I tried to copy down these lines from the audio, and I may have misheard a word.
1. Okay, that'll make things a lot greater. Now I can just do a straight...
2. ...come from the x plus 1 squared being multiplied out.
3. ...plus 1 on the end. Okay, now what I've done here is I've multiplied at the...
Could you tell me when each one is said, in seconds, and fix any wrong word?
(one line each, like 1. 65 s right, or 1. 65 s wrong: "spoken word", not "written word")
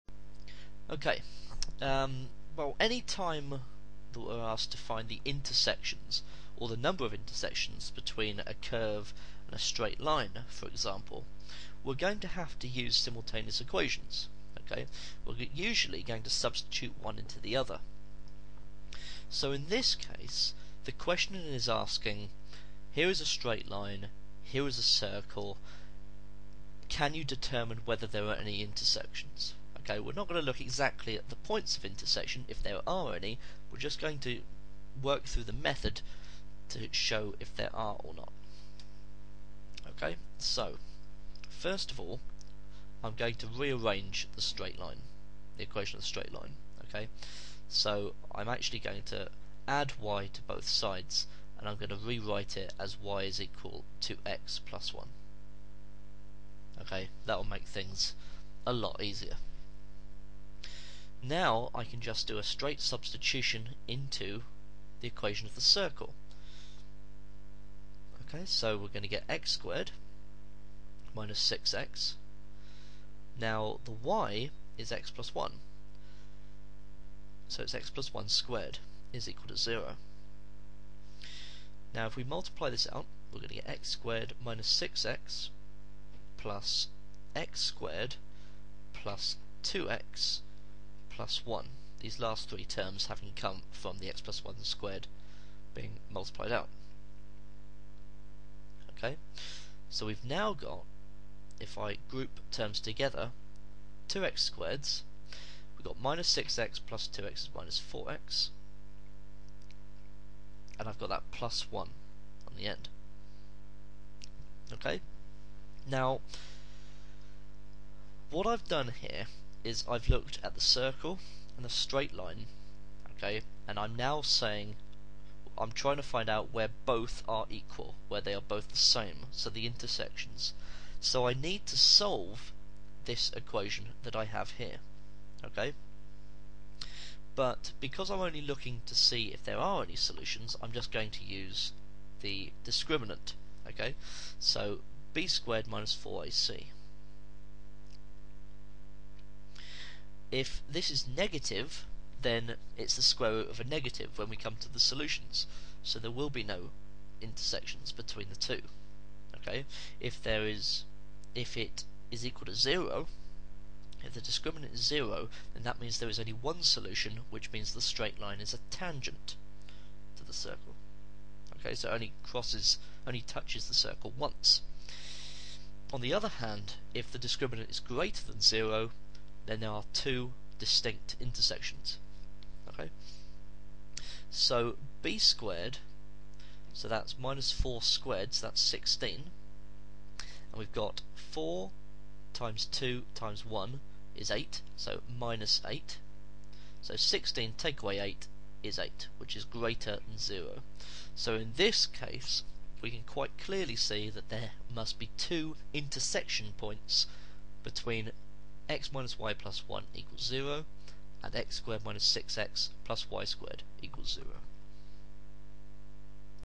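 1. 56 s wrong: "easier", not "greater"
2. 93 s right
3. 111 s wrong: "looked", not "multiplied".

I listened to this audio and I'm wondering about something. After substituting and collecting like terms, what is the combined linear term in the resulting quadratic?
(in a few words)
-4x.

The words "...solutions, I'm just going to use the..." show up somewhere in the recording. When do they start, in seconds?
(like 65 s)
139 s.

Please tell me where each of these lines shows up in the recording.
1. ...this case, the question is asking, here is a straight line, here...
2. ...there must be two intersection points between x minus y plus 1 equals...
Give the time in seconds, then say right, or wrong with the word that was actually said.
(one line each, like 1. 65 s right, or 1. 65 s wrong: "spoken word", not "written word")
1. 19 s right
2. 204 s right.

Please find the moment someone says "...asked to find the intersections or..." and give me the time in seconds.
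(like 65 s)
4 s.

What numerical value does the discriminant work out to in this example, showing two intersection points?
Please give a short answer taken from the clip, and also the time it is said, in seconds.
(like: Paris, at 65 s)
8, at 196 s.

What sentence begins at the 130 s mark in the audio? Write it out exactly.
So I need to solve this equation that I have here, okay?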